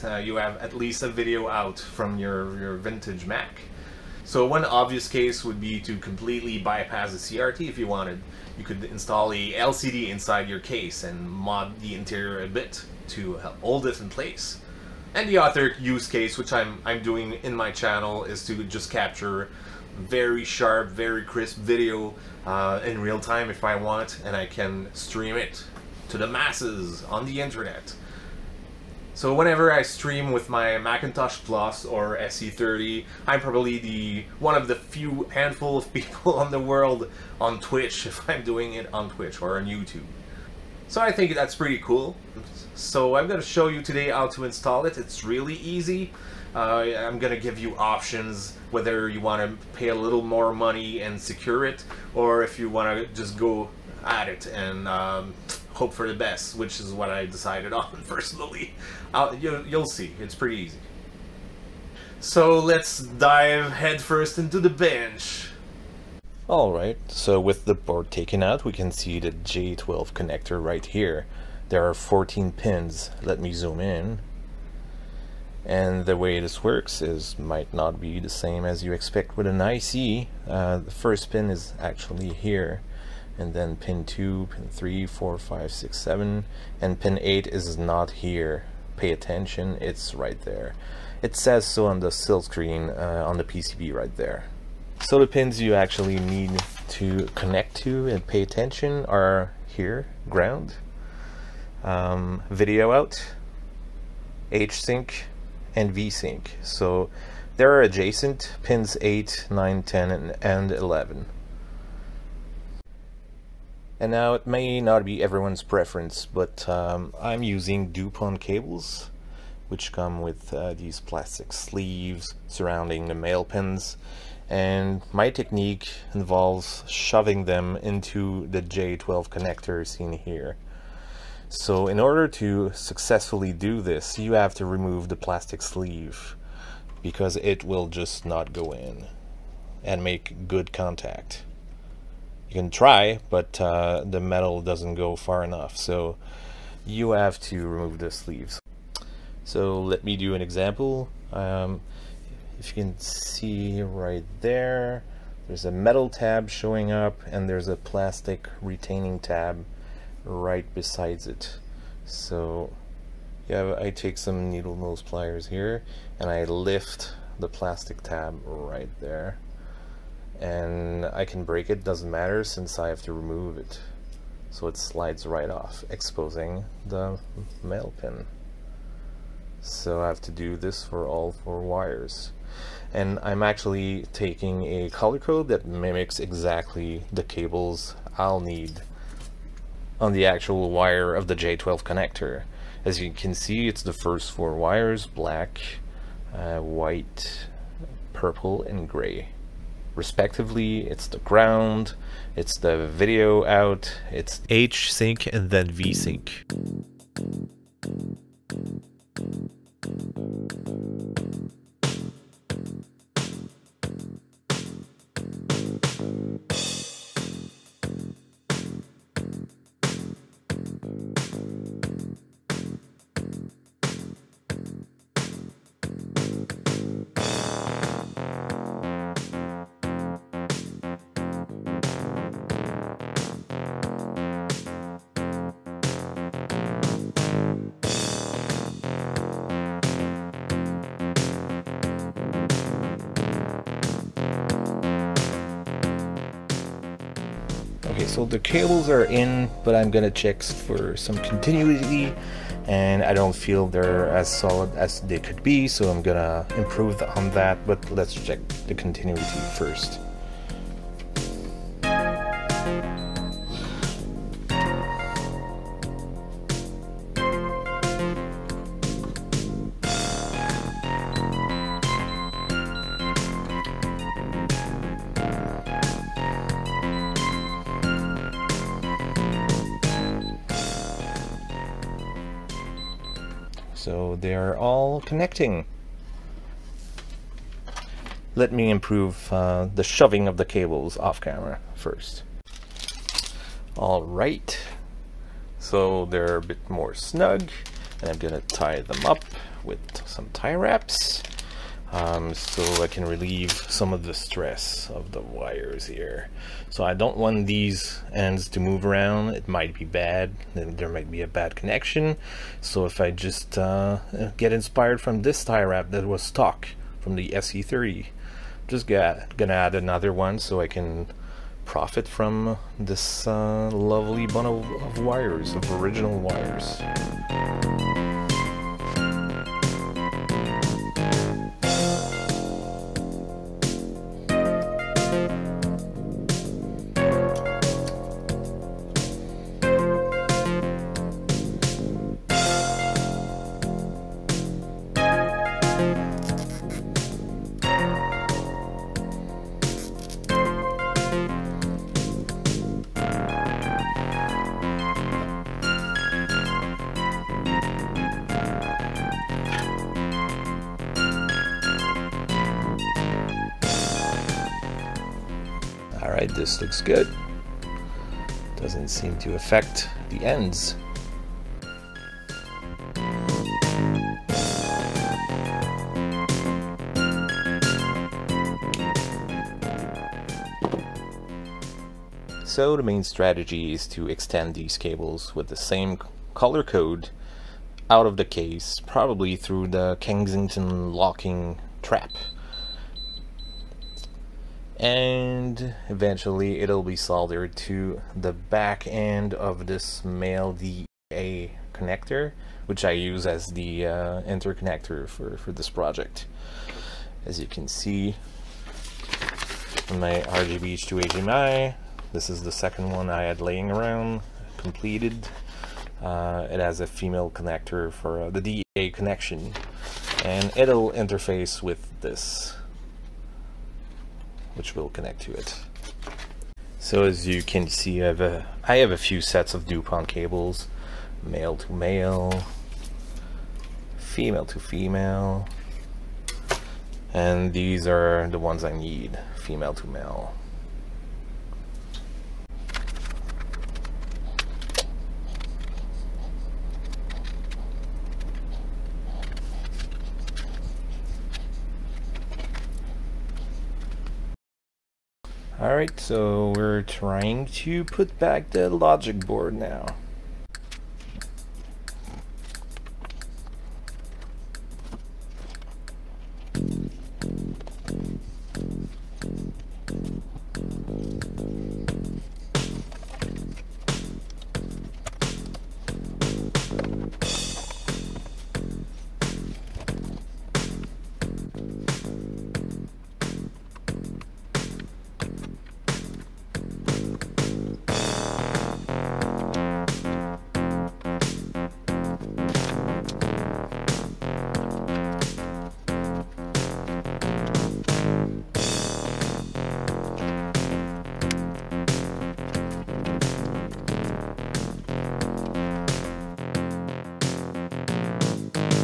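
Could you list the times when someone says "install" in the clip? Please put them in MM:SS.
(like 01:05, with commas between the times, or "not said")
00:08, 00:44.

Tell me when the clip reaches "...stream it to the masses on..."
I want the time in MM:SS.
00:24.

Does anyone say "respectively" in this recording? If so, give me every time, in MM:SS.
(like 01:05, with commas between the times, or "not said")
03:19.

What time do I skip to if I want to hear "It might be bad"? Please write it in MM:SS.
05:09.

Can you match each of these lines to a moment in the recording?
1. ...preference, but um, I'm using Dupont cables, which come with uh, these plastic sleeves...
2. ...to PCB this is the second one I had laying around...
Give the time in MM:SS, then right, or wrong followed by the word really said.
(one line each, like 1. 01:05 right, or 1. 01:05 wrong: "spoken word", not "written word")
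1. 01:55 right
2. 06:50 wrong: "HDMI", not "PCB".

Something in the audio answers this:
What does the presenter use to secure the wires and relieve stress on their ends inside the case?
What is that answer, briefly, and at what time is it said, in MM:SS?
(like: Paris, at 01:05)
Tie wraps, at 05:00.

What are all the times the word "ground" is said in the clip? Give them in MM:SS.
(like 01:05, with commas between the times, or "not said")
01:40, 03:21.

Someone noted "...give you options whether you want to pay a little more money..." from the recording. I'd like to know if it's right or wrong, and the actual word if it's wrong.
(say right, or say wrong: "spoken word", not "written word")
right.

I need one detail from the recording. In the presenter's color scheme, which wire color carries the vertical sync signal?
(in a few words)
Gray.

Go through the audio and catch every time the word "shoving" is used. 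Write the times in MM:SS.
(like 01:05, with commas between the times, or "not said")
02:06, 04:49.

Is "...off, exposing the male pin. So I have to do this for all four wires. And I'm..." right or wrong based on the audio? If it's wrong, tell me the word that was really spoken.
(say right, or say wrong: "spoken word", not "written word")
right.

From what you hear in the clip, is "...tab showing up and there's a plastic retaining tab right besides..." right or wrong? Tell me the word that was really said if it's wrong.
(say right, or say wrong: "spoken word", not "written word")
right.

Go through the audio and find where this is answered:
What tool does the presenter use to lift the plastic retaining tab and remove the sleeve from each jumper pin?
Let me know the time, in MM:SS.
02:44.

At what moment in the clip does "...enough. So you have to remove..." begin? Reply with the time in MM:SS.
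02:25.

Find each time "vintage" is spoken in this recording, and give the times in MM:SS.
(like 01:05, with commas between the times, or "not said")
00:02.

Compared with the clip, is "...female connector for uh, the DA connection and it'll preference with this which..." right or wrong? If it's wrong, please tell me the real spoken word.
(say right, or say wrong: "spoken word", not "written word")
wrong: "interface", not "preference".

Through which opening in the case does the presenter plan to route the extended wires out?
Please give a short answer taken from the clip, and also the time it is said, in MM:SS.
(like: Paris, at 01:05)
Kensington locking trap, at 06:29.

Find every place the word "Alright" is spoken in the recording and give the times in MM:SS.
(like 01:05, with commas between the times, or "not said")
01:06, 07:35.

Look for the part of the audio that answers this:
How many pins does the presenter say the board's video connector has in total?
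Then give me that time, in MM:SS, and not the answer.
01:11.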